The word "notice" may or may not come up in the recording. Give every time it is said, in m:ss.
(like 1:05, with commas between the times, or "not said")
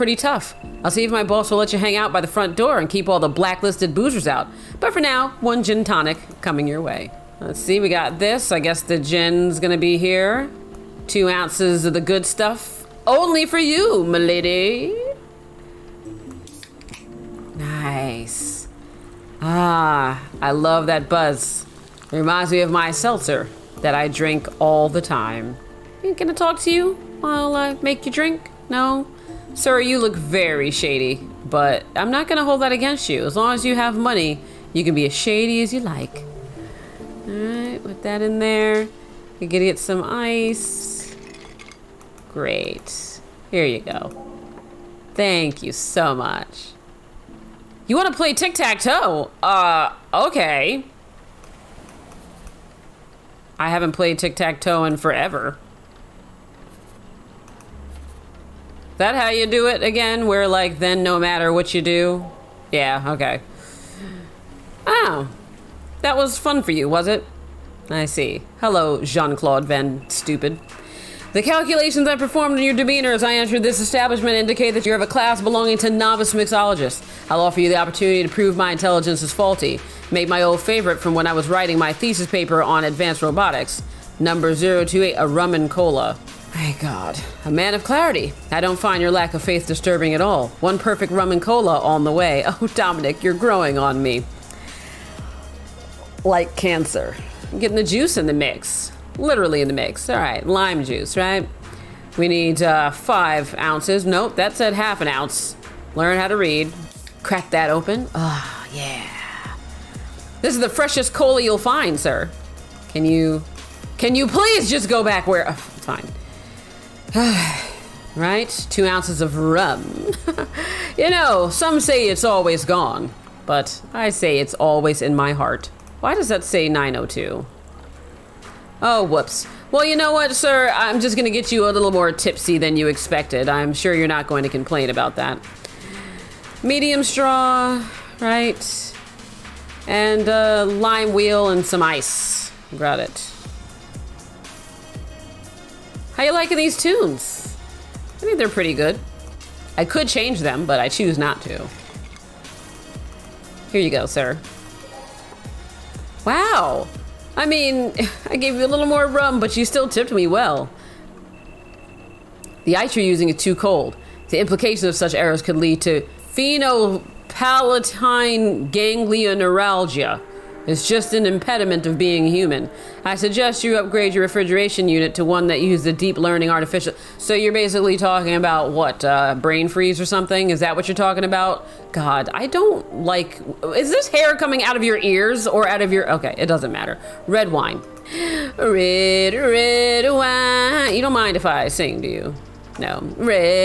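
not said.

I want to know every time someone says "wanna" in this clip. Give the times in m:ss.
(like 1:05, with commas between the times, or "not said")
0:47.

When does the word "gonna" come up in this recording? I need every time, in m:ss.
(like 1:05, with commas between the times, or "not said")
0:09, 0:32, 0:39, 2:11.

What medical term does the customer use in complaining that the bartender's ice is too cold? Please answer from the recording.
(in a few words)
Sphenopalatine neuralgia.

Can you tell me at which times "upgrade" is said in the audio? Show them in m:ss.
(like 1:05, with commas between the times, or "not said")
2:53.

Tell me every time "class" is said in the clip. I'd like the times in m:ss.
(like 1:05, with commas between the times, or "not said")
1:15.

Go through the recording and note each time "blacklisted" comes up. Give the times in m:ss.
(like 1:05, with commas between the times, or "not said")
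0:03.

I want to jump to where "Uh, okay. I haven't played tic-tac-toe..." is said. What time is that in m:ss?
0:49.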